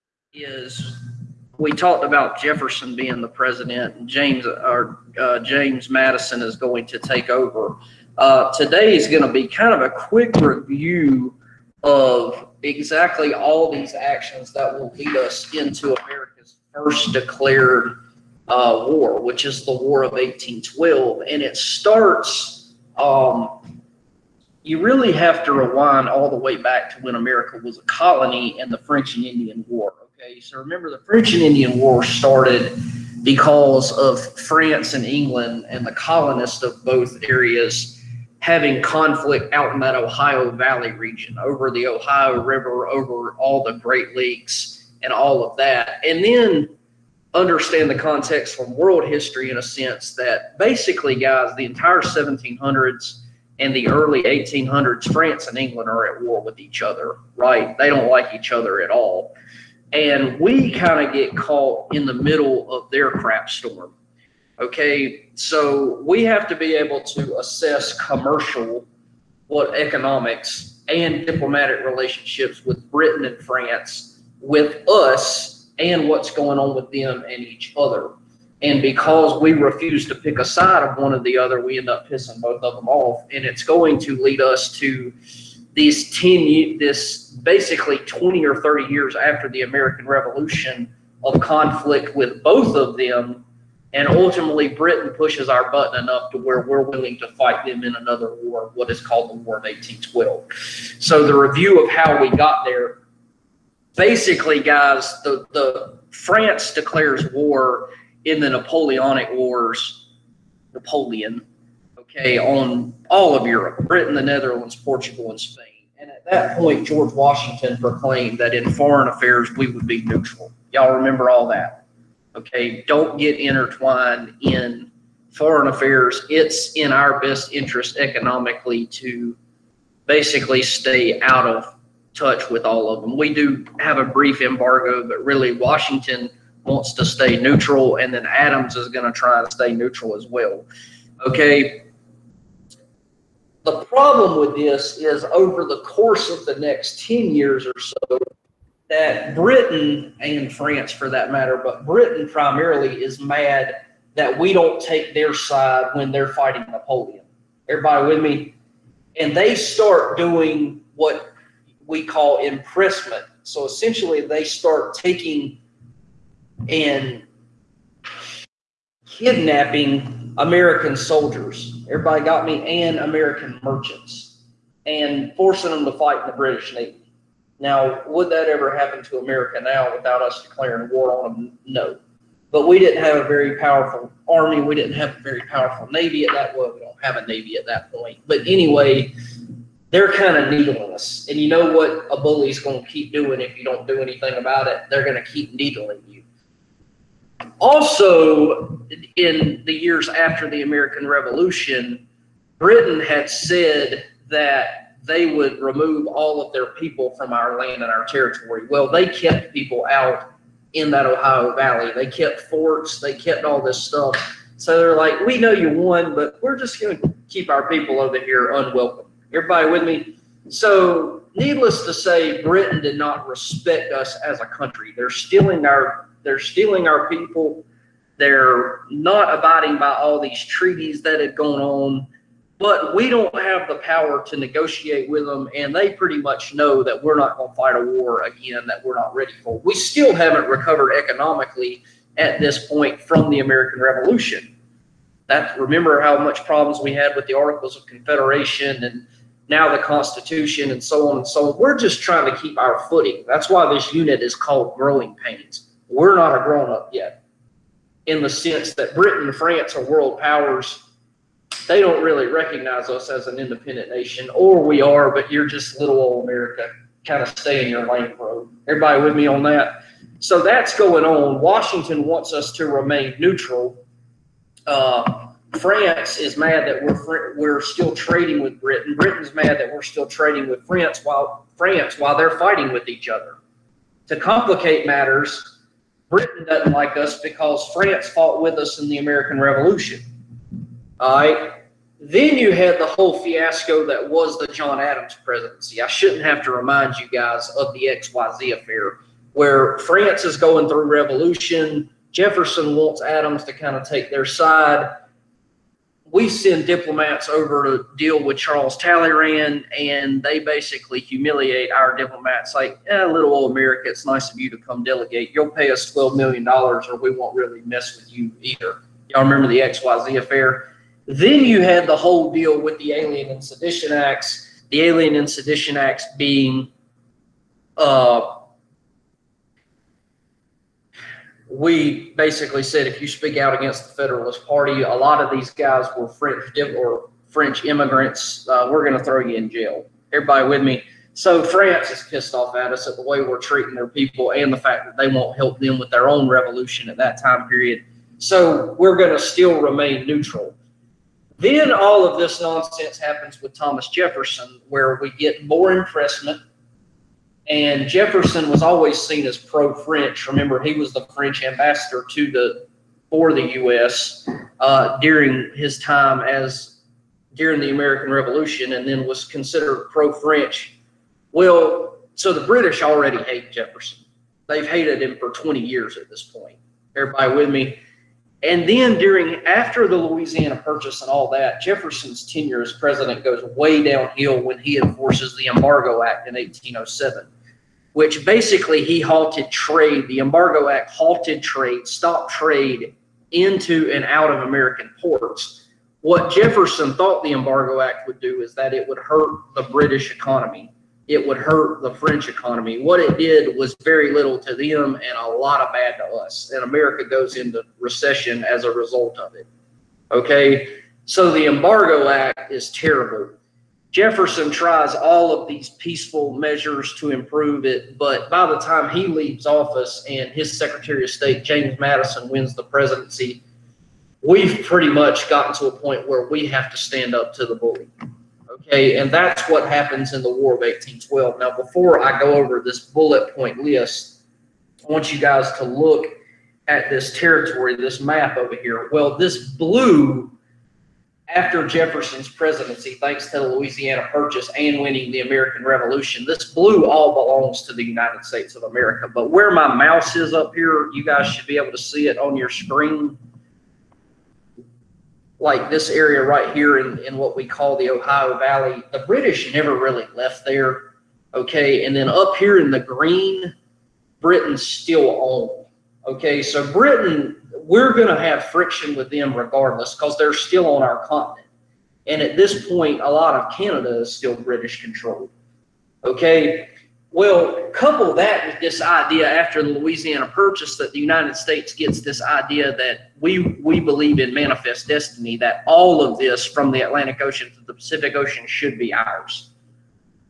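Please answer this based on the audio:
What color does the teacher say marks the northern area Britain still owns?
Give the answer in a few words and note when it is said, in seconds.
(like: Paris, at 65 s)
green, at 462 s.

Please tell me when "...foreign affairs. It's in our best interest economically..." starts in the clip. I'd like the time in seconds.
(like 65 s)
125 s.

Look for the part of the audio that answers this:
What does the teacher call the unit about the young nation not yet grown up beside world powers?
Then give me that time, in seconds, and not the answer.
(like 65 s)
254 s.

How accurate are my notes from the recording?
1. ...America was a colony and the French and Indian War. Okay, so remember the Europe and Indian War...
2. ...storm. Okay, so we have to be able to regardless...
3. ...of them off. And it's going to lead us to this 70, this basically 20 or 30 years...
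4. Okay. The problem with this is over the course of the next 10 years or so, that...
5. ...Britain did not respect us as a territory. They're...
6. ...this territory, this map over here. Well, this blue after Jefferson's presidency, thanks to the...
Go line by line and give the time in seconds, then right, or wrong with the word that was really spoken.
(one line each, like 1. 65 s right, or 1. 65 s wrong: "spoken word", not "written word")
1. 27 s wrong: "French", not "Europe"
2. 63 s wrong: "assess", not "regardless"
3. 82 s wrong: "10", not "70"
4. 141 s right
5. 222 s wrong: "country", not "territory"
6. 436 s right.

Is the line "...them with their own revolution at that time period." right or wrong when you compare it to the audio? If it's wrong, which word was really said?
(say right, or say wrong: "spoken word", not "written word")
right.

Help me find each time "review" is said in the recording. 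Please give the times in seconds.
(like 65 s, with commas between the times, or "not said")
10 s, 101 s.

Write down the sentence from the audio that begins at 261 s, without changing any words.
They don't really recognize us as an independent nation, or we are, but you're just little old America.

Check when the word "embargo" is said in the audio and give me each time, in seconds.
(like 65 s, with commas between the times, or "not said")
134 s, 385 s, 390 s, 397 s, 411 s.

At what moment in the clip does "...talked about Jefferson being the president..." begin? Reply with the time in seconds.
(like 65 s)
1 s.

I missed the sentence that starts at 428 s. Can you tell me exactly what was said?
Okay, and that's what happens in the War of 1812.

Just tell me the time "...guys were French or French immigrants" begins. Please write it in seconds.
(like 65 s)
335 s.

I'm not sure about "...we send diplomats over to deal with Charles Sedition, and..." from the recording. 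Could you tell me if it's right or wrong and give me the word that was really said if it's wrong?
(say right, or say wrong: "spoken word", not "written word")
wrong: "Talleyrand", not "Sedition".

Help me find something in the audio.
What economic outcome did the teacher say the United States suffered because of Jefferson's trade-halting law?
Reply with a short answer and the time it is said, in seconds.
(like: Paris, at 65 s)
recession, at 407 s.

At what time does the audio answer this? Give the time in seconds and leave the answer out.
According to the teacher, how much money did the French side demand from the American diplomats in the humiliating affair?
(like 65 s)
315 s.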